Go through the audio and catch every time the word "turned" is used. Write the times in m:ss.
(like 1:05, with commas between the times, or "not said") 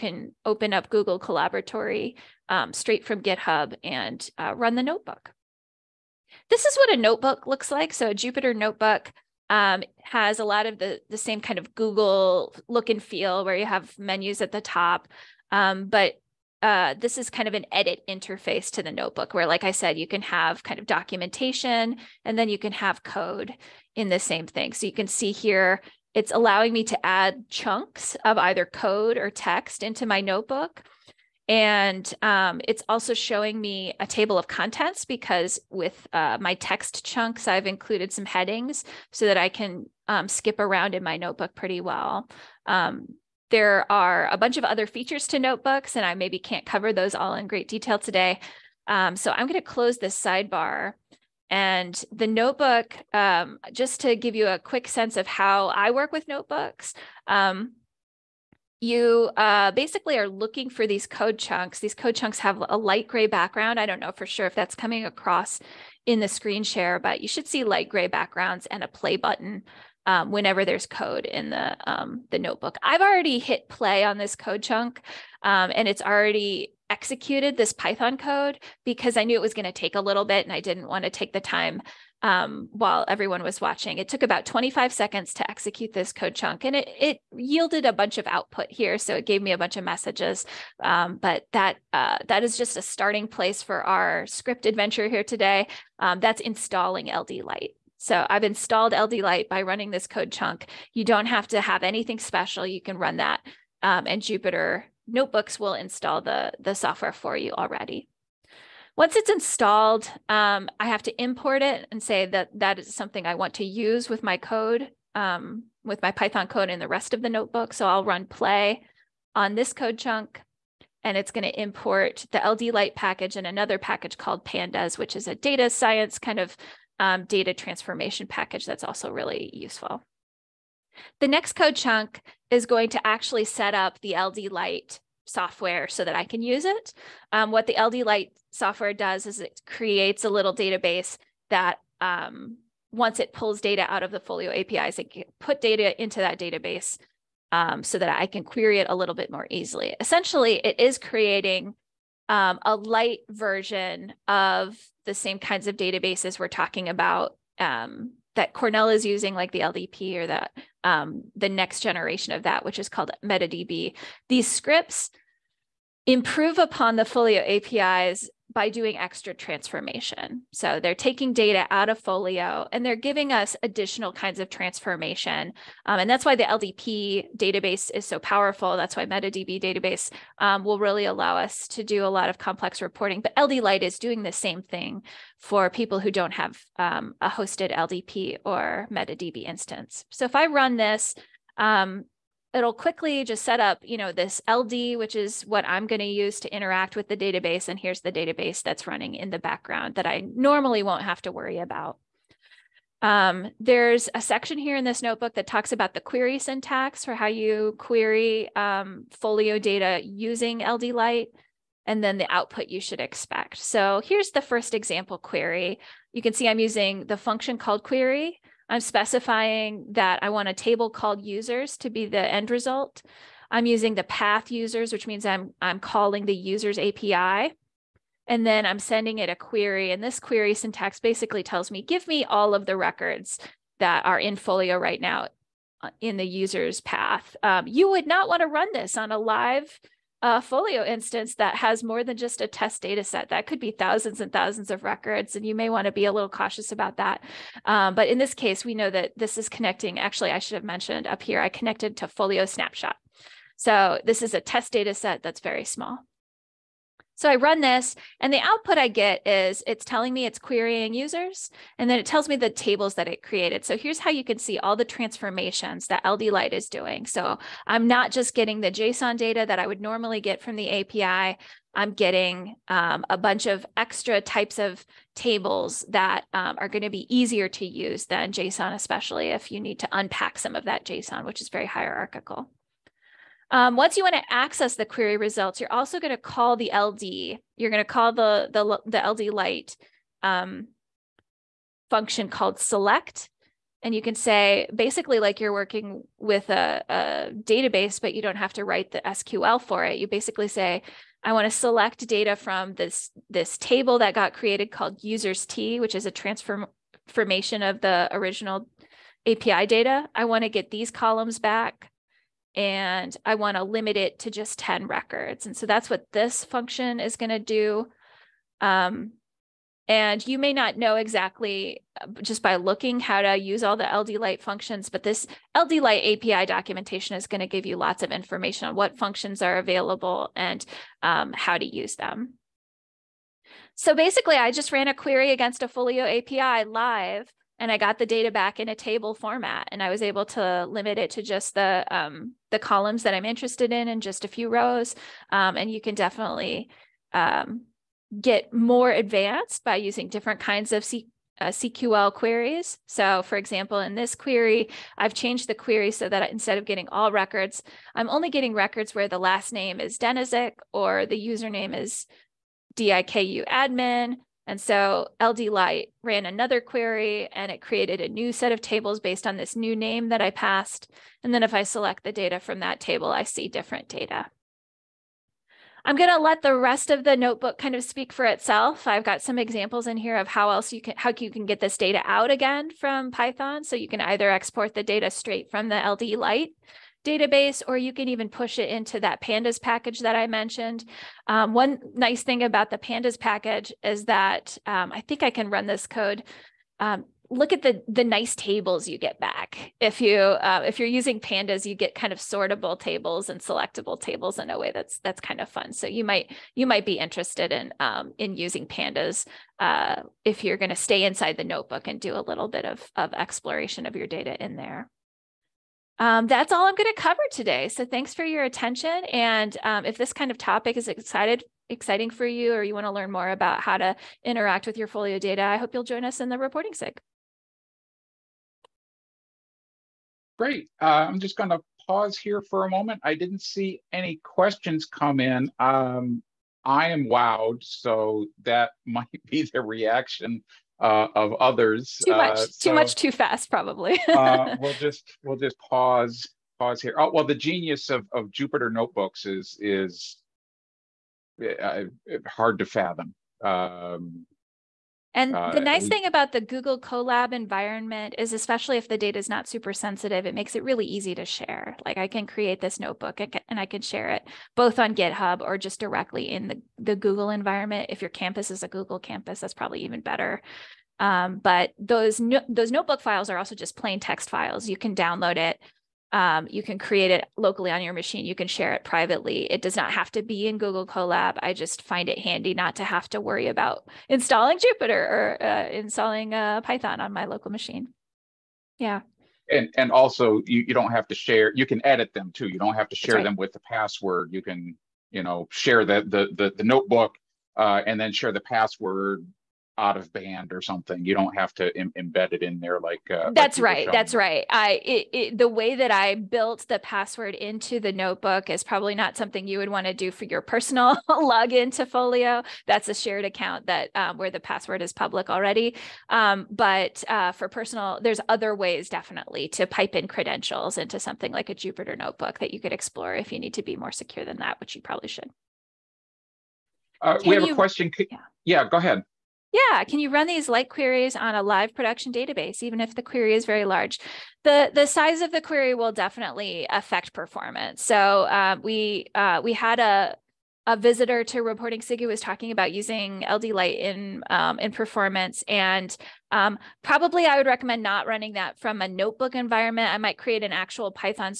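not said.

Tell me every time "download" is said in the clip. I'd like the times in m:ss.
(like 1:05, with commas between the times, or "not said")
7:54.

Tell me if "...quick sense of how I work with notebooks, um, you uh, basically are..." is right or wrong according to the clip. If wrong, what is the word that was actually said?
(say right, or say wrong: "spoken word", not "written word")
right.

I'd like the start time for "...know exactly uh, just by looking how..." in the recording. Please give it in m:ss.
5:20.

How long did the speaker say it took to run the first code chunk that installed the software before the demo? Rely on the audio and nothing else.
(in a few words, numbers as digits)
25 seconds.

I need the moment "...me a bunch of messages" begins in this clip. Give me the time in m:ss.
1:29.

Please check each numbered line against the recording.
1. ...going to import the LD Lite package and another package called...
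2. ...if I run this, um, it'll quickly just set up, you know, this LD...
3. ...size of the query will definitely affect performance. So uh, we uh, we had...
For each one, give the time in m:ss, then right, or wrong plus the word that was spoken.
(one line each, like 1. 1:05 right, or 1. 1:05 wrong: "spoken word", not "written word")
1. 2:01 right
2. 3:10 right
3. 8:54 right.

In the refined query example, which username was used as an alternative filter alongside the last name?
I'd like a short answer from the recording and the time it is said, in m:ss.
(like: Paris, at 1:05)
DIKU admin, at 6:02.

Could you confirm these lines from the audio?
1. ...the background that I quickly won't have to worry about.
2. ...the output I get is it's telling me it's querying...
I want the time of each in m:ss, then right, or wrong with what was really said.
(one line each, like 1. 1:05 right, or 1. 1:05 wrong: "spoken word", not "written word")
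1. 3:19 wrong: "normally", not "quickly"
2. 4:18 right.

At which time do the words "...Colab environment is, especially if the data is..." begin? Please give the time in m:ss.
7:36.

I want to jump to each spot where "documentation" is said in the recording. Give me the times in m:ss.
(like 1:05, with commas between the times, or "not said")
0:20, 5:26.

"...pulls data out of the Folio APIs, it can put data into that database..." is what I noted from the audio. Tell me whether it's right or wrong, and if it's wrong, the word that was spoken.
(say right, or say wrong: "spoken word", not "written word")
right.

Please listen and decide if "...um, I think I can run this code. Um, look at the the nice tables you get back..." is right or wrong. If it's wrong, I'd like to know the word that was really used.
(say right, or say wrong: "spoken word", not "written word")
right.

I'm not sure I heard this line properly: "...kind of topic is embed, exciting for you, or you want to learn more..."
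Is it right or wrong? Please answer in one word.
wrong.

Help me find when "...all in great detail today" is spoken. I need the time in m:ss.
0:47.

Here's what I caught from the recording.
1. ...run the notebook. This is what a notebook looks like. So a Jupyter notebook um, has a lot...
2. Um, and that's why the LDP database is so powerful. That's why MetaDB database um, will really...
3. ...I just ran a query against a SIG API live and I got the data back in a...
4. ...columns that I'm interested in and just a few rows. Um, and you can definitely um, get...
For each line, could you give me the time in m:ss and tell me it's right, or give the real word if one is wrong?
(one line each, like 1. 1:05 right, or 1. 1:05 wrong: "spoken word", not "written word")
1. 0:04 right
2. 2:55 right
3. 5:34 wrong: "Folio", not "SIG"
4. 5:42 right.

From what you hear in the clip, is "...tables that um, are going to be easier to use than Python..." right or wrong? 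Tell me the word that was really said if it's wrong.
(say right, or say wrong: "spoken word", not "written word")
wrong: "JSON", not "Python".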